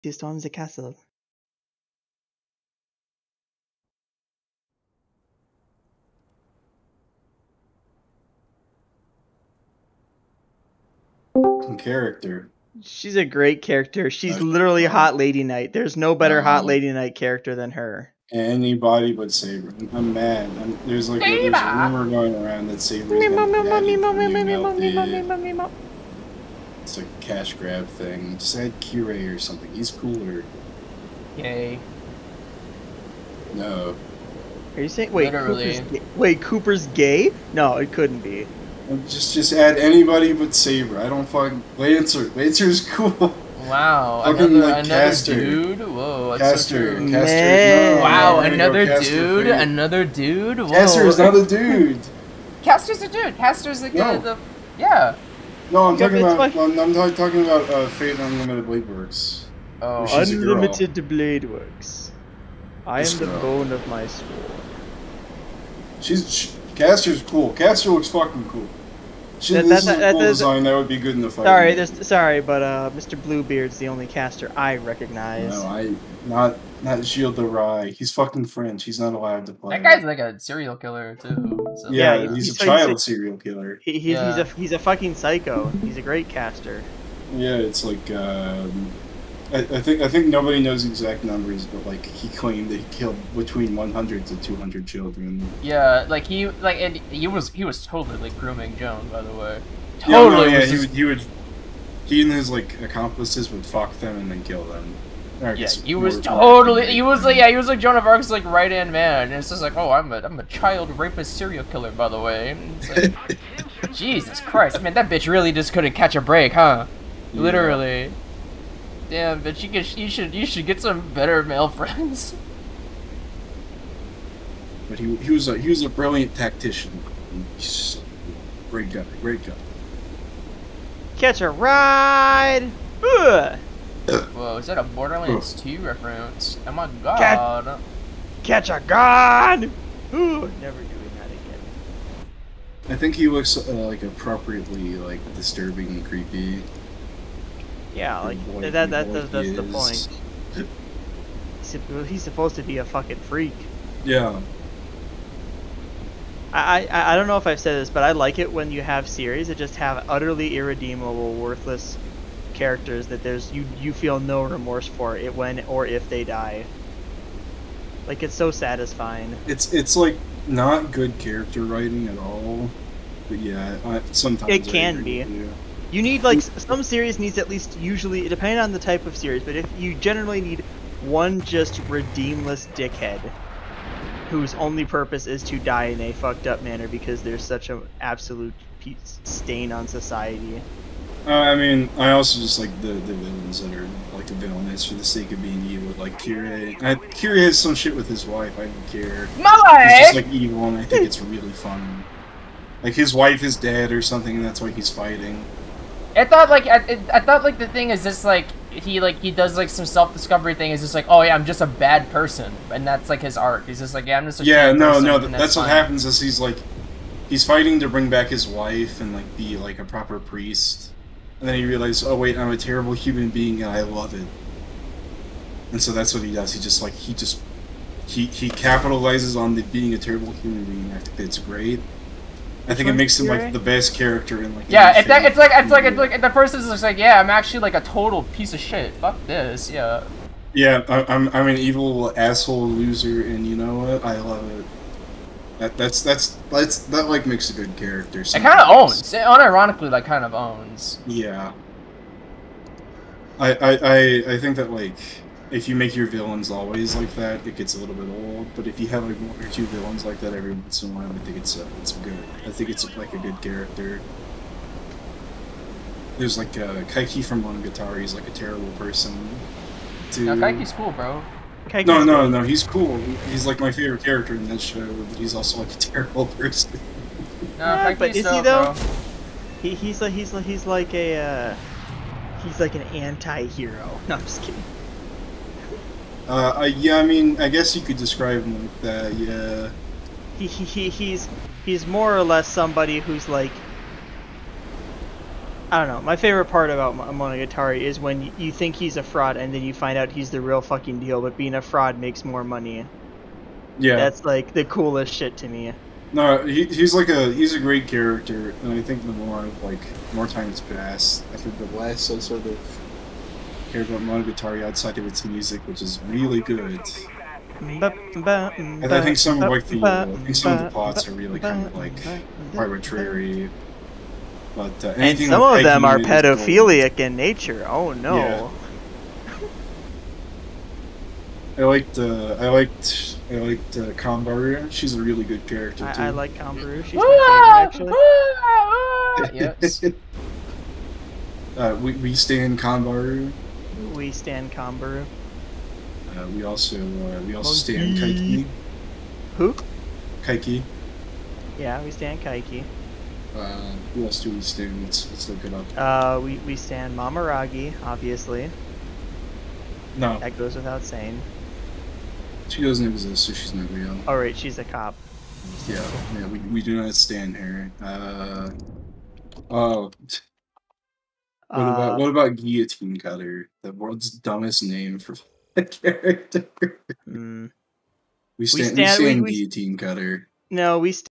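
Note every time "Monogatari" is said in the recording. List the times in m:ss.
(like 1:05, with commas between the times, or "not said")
4:27, 4:56, 5:14.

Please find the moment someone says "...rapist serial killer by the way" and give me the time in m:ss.
1:50.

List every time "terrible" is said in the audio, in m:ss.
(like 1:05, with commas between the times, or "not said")
3:42, 3:49, 4:28, 4:35.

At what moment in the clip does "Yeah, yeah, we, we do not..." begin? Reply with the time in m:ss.
6:05.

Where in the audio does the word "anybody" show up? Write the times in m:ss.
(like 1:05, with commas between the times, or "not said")
0:18, 0:39.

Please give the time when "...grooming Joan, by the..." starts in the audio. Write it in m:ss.
1:38.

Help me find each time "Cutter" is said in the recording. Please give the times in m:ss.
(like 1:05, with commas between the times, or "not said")
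6:12, 6:19.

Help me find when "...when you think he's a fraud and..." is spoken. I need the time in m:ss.
4:57.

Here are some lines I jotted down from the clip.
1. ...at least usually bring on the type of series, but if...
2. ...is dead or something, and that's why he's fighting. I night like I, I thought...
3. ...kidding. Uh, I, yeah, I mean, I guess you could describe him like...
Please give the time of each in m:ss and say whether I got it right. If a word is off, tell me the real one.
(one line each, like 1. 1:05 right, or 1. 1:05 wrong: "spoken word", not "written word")
1. 2:57 wrong: "depending", not "bring"
2. 3:23 wrong: "thought", not "night"
3. 4:44 right.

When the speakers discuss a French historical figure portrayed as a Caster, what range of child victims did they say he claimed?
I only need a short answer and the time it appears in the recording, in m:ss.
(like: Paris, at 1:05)
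100 to 200, at 1:33.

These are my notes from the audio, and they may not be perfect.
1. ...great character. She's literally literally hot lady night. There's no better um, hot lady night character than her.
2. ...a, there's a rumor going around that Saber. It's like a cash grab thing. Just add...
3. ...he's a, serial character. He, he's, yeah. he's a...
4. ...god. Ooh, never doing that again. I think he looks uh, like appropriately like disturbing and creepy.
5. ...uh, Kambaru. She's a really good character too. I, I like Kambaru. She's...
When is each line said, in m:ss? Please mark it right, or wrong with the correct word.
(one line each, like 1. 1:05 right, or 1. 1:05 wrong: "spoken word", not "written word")
1. 0:13 right
2. 0:21 right
3. 1:22 wrong: "killer", not "character"
4. 2:18 right
5. 5:33 right.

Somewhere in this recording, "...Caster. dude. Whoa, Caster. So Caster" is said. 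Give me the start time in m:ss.
0:44.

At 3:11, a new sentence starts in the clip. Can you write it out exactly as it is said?
Uh, I mean, I also just like the, the villains that are like the villainous for the sake of being evil.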